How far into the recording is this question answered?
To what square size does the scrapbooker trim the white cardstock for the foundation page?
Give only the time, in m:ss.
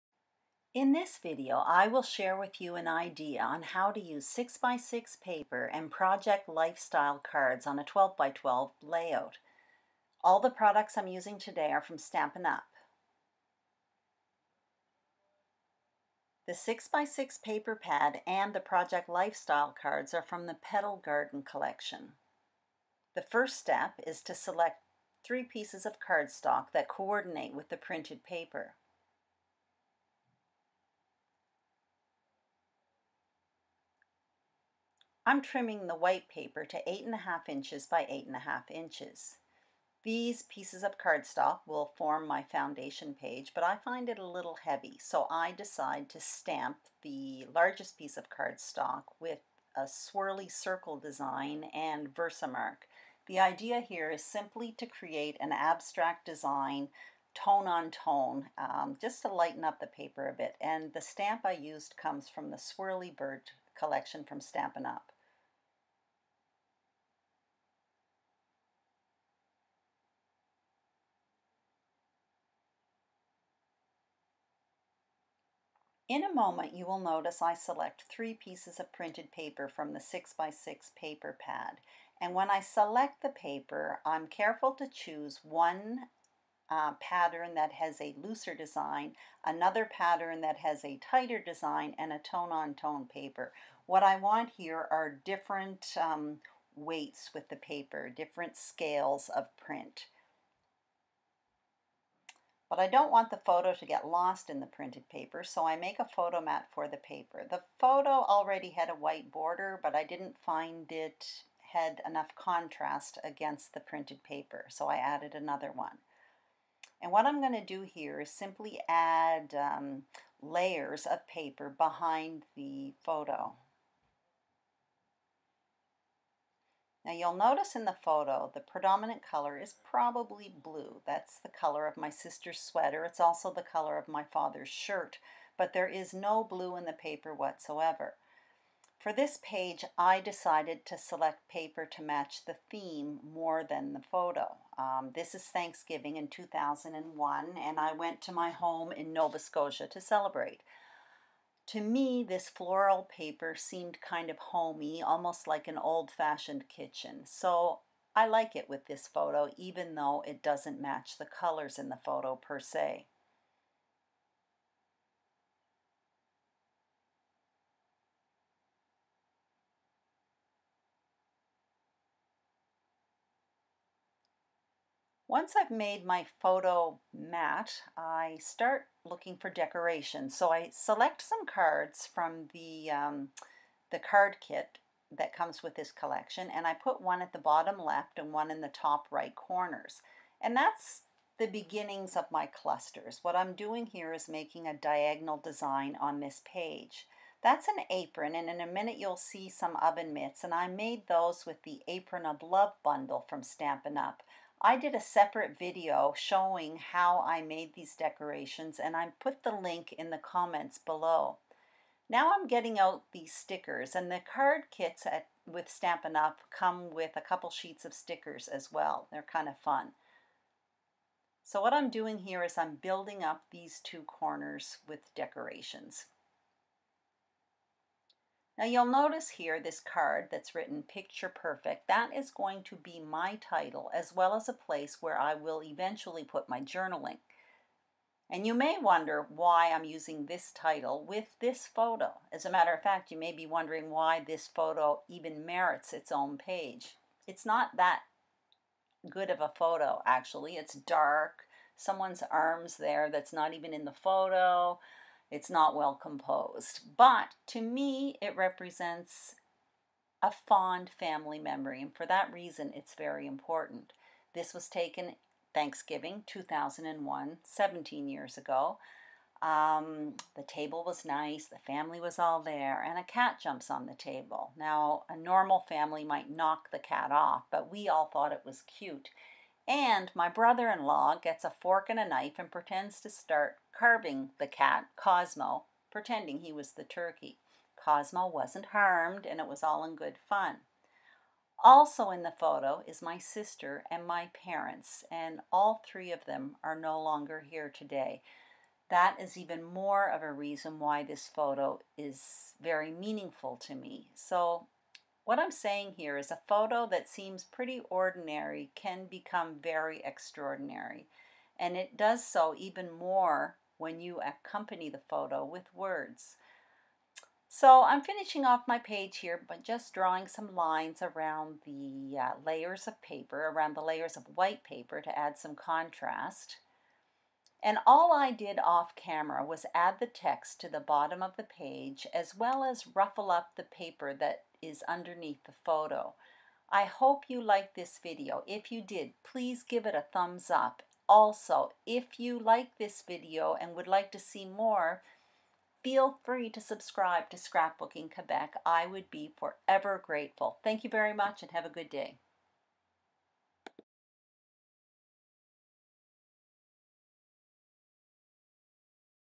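0:36.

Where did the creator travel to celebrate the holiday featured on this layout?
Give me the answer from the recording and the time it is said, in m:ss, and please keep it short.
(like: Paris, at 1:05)
Nova Scotia, at 2:29.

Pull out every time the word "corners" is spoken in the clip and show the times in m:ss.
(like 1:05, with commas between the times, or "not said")
3:09, 3:44.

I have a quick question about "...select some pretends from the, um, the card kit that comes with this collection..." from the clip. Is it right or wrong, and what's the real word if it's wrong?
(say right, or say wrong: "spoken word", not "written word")
wrong: "cards", not "pretends".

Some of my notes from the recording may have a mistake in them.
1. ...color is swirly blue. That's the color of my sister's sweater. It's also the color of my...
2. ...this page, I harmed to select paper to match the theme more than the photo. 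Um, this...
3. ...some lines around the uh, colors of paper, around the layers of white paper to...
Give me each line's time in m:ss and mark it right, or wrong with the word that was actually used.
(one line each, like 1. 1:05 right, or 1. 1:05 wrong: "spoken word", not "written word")
1. 2:09 wrong: "probably", not "swirly"
2. 2:19 wrong: "decided", not "harmed"
3. 5:20 wrong: "layers", not "colors".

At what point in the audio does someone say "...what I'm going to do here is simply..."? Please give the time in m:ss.
1:57.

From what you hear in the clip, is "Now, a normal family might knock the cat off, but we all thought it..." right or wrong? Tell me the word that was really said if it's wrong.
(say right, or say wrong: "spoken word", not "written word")
right.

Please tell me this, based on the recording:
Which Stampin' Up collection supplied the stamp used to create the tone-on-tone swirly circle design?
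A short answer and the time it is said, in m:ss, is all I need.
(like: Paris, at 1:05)
Swirly Bird, at 1:02.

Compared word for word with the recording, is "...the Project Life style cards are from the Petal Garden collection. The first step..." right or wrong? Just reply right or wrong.
right.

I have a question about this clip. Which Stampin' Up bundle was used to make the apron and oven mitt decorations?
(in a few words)
Apron of Love.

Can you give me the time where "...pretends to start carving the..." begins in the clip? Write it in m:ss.
4:42.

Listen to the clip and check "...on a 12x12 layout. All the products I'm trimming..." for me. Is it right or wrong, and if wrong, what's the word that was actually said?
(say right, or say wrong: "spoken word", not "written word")
wrong: "using", not "trimming".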